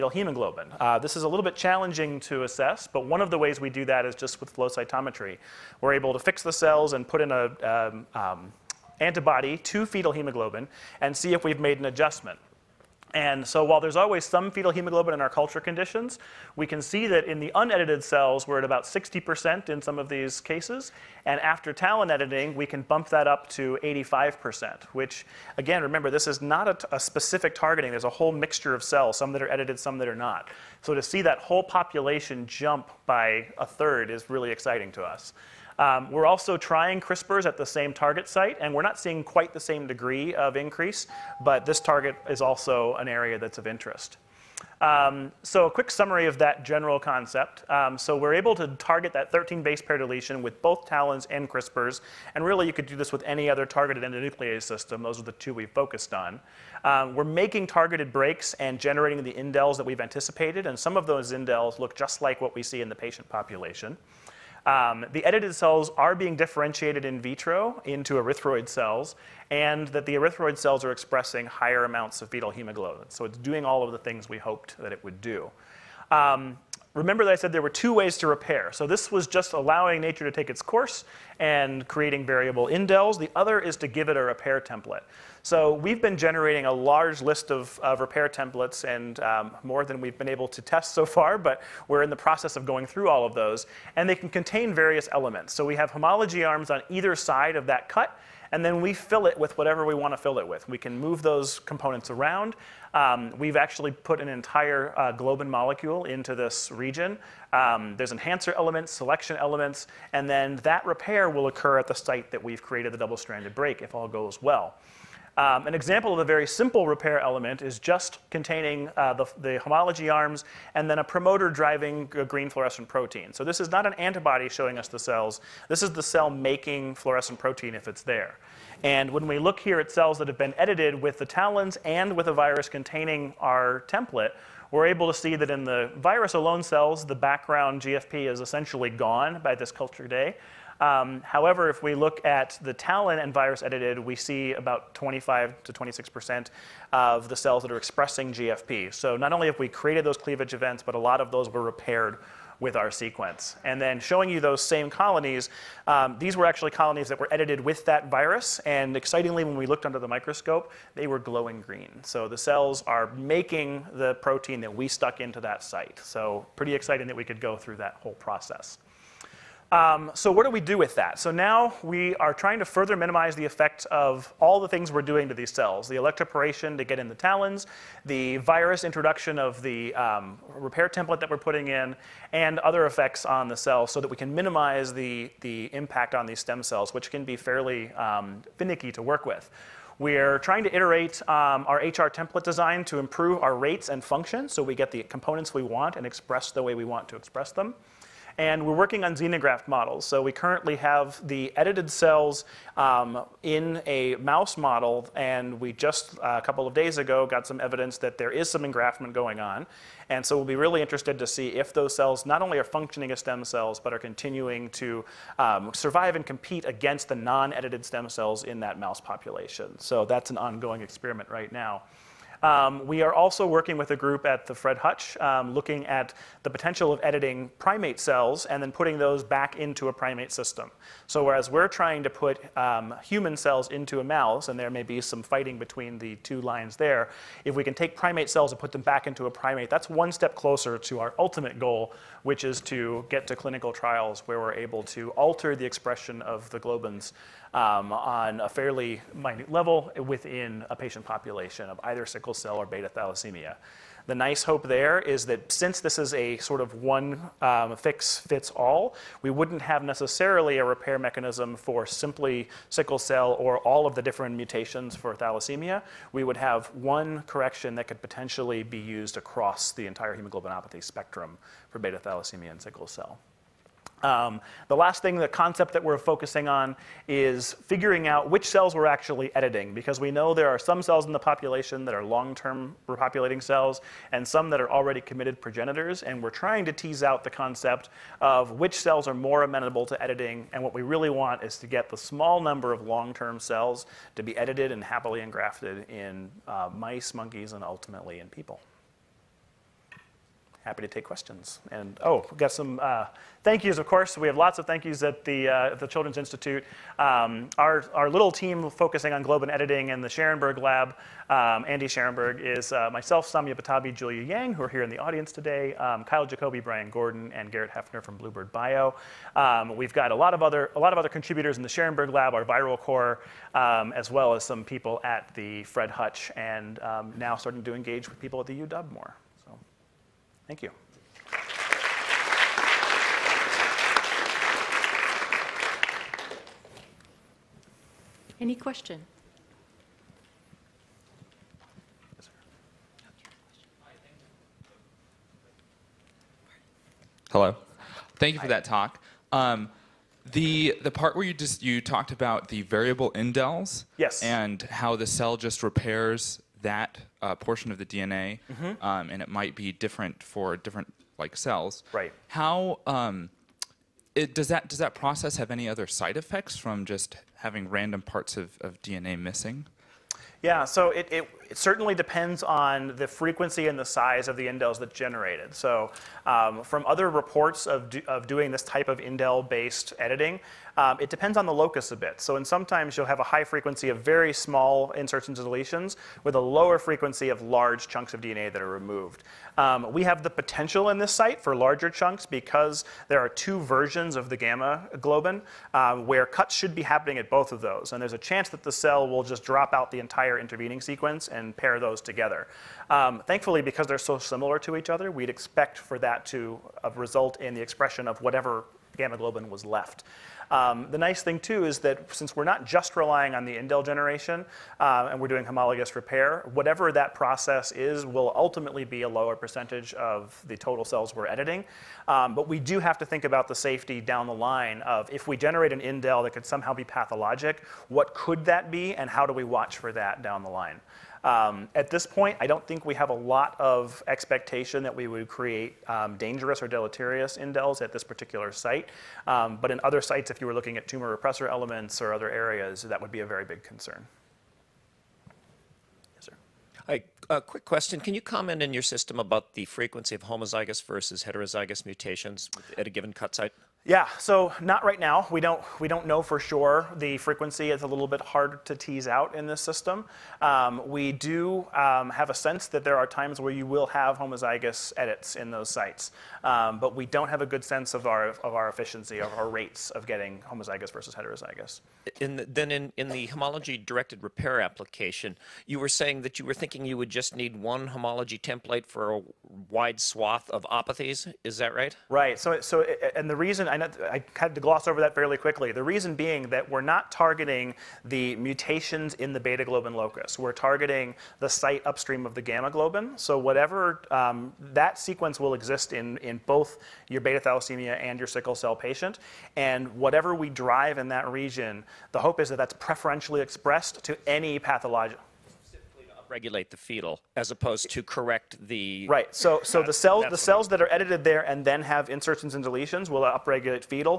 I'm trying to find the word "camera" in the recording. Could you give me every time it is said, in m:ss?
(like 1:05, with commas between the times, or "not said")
not said.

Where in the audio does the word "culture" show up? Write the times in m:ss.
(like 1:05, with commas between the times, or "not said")
0:15, 2:19.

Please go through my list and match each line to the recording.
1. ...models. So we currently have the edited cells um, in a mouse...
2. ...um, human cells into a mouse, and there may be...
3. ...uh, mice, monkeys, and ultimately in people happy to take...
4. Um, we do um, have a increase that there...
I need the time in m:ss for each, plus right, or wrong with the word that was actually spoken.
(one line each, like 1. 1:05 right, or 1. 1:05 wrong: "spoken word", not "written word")
1. 3:19 right
2. 3:52 right
3. 4:56 right
4. 7:40 wrong: "sense", not "increase".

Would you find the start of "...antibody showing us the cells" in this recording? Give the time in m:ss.
2:03.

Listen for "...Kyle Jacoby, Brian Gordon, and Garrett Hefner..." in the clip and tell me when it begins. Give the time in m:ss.
5:16.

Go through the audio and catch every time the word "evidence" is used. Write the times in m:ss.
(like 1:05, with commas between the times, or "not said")
3:27.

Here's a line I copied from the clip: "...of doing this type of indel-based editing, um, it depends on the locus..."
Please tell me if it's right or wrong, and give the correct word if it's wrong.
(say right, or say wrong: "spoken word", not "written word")
right.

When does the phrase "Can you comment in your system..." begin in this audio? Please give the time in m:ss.
7:27.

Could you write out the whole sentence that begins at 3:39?
So that's an ongoing experiment right now.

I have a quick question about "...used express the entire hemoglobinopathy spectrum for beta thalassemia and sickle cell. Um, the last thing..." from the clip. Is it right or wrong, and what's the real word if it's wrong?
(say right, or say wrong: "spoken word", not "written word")
wrong: "across", not "express".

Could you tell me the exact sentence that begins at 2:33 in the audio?
And then showing you those same colonies, um, these were actually colonies that were edited with that virus.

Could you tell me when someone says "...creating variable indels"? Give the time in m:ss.
1:21.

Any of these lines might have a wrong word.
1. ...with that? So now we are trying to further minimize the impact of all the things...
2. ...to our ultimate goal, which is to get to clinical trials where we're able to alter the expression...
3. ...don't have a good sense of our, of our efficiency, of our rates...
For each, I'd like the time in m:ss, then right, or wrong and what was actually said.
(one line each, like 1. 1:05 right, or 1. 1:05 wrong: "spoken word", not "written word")
1. 2:50 wrong: "effect", not "impact"
2. 4:00 right
3. 7:47 right.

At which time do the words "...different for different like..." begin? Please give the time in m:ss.
5:59.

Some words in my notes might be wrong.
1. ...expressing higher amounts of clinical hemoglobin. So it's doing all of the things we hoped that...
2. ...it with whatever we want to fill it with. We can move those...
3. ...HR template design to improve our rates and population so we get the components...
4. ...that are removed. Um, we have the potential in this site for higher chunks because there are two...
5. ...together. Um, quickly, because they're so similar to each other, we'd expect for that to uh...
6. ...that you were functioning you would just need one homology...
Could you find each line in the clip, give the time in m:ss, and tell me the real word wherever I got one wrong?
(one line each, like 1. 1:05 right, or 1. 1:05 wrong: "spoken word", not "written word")
1. 1:10 wrong: "fetal", not "clinical"
2. 1:39 right
3. 3:11 wrong: "function", not "population"
4. 6:28 wrong: "larger", not "higher"
5. 6:42 wrong: "thankfully", not "quickly"
6. 7:56 wrong: "thinking", not "functioning".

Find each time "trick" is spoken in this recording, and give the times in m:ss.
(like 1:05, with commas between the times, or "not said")
not said.